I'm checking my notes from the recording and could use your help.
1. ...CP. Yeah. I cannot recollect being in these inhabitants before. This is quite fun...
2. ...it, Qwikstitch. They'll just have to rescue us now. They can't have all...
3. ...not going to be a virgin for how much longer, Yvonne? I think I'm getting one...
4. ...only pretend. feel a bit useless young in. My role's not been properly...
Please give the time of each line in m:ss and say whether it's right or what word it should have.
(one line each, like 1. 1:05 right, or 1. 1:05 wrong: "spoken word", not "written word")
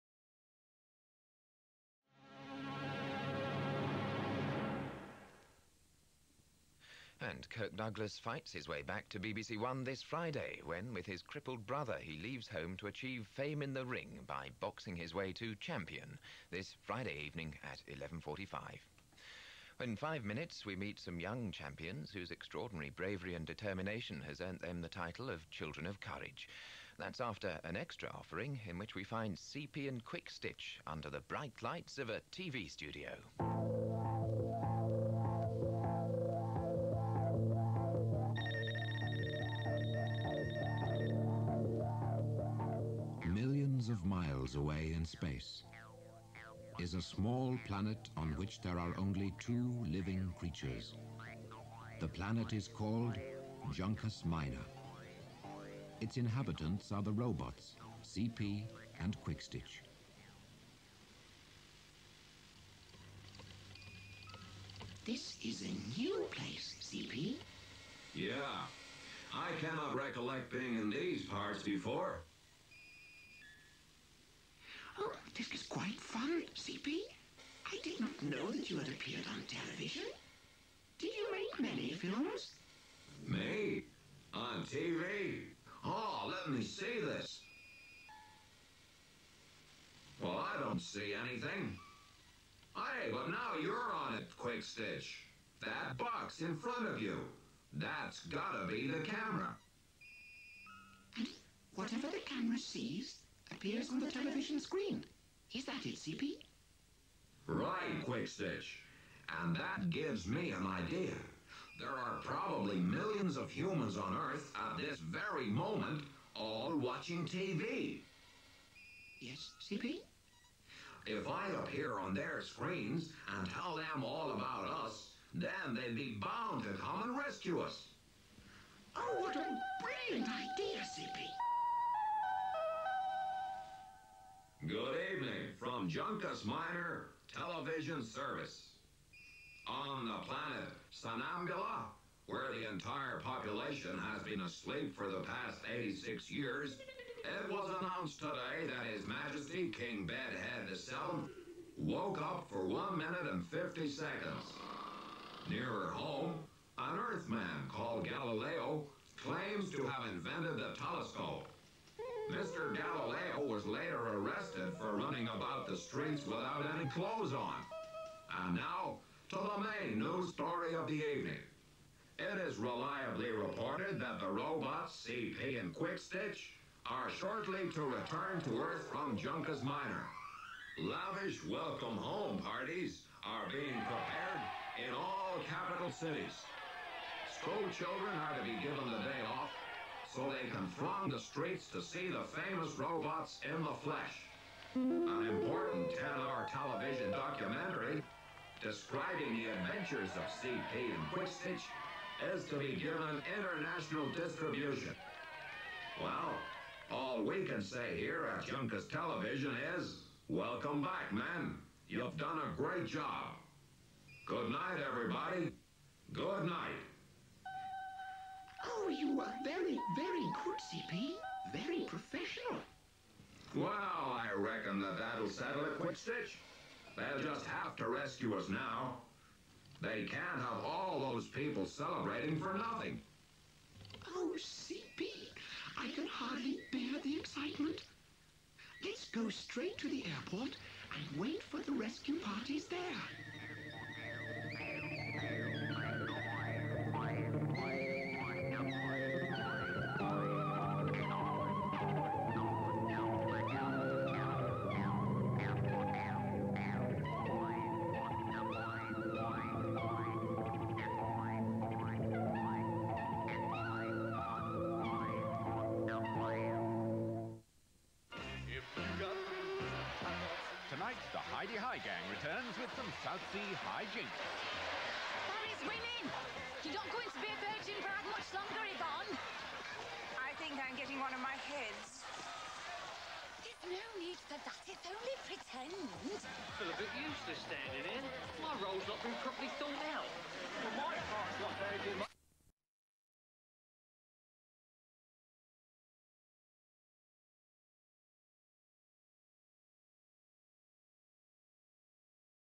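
1. 1:06 wrong: "parts", not "inhabitants"
2. 3:45 right
3. 4:36 right
4. 4:44 wrong: "standing", not "young".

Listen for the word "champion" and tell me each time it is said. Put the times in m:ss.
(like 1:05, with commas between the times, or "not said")
0:15, 0:21.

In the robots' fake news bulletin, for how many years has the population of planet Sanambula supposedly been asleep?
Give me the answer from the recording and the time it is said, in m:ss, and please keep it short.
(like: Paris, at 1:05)
86, at 2:25.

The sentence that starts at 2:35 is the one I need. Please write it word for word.
Nearer home, an Earthman called Galileo claims to have invented the telescope.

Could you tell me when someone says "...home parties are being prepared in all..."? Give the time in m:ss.
3:01.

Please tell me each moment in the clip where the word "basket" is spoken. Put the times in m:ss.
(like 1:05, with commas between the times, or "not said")
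not said.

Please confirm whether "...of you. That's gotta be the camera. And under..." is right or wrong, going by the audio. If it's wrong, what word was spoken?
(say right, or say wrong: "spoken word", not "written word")
wrong: "whatever", not "under".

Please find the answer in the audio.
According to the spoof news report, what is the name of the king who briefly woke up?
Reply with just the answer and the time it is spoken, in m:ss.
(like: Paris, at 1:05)
King Bedhead VII, at 2:29.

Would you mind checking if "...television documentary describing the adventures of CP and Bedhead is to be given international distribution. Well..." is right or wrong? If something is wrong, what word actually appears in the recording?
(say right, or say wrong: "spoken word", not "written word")
wrong: "Qwikstitch", not "Bedhead".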